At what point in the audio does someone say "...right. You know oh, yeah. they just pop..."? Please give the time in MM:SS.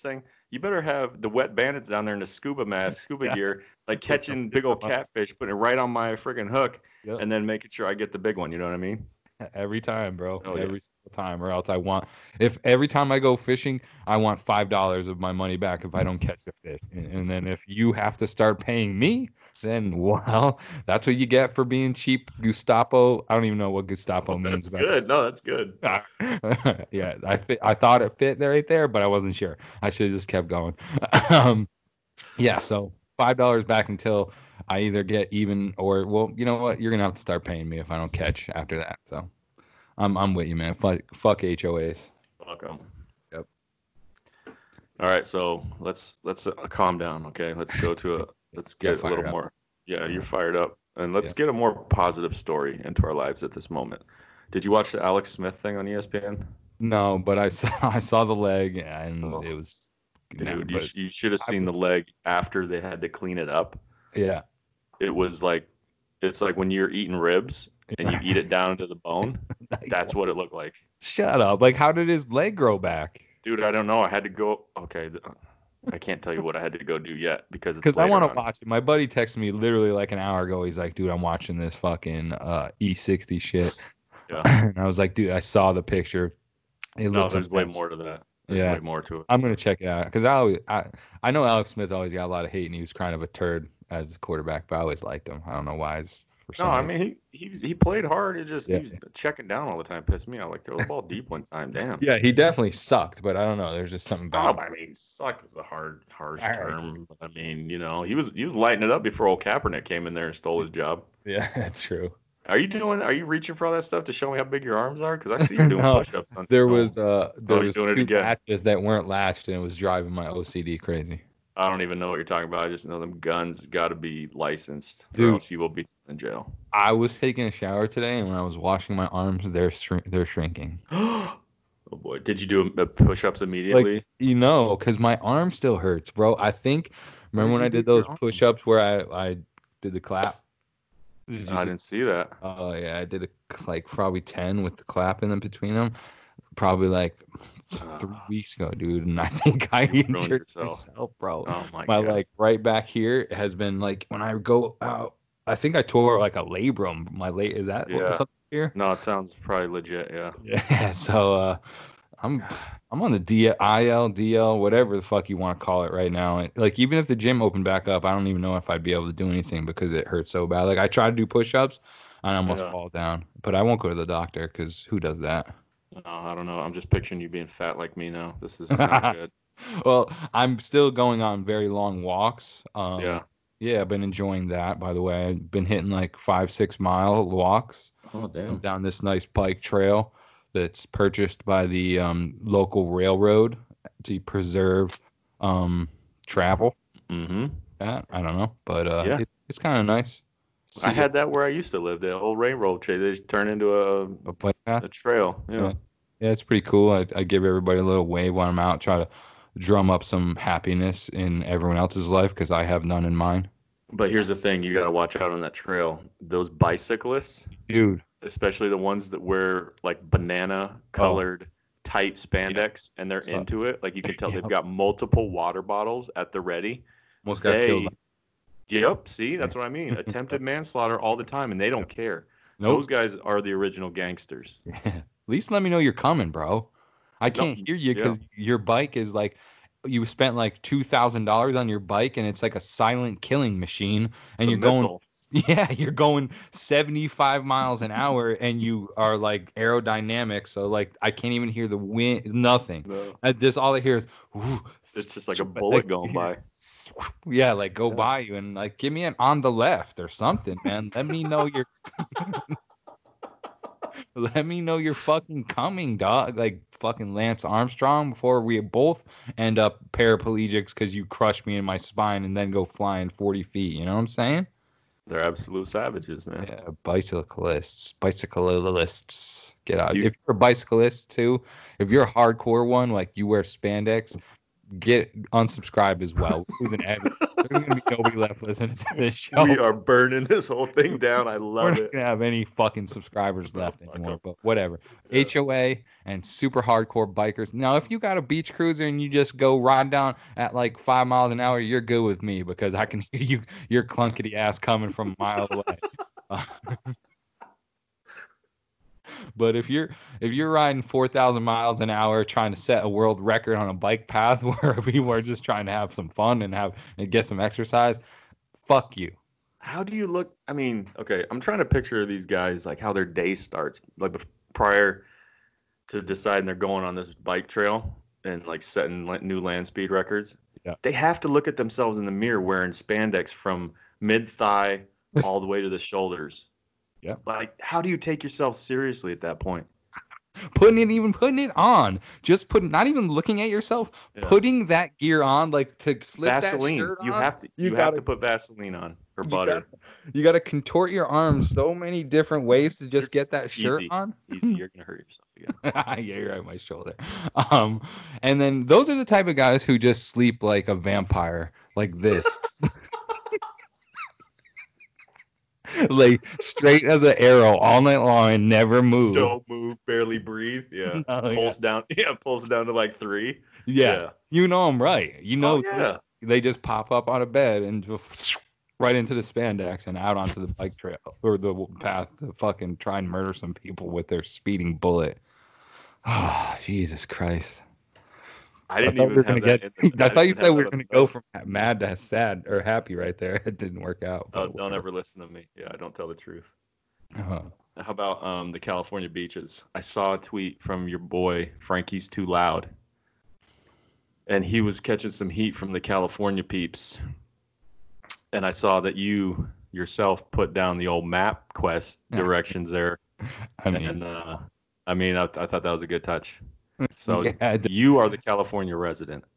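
06:14.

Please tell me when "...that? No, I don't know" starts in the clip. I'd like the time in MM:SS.
02:55.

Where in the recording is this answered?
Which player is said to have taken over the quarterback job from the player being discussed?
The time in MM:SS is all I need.
01:49.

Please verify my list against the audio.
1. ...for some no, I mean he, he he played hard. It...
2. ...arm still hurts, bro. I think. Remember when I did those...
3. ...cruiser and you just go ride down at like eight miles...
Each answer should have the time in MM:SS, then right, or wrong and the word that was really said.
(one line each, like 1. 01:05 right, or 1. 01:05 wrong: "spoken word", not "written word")
1. 01:36 right
2. 02:15 right
3. 04:58 wrong: "five", not "eight".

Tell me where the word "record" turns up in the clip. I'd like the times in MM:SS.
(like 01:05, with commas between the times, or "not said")
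05:13, 05:29.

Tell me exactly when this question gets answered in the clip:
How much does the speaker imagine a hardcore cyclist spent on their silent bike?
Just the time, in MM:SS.
04:00.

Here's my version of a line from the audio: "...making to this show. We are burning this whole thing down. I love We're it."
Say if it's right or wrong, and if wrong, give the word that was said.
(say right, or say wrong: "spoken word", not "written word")
wrong: "listening", not "making".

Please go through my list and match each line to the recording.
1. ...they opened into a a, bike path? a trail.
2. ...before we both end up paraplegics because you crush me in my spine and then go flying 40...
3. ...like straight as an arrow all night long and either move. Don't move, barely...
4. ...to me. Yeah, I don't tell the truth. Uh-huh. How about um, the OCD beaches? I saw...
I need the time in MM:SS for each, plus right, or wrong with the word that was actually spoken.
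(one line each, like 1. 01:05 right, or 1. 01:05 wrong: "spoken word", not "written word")
1. 03:22 wrong: "turned", not "opened"
2. 04:28 right
3. 06:05 wrong: "never", not "either"
4. 06:35 wrong: "California", not "OCD".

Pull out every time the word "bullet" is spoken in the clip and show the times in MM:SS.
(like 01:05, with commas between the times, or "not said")
04:15, 06:24.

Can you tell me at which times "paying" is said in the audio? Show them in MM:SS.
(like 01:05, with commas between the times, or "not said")
00:18, 00:37.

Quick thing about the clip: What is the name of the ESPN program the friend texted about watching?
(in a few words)
E60.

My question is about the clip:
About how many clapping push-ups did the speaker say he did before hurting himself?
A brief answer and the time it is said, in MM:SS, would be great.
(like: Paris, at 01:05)
10, at 02:24.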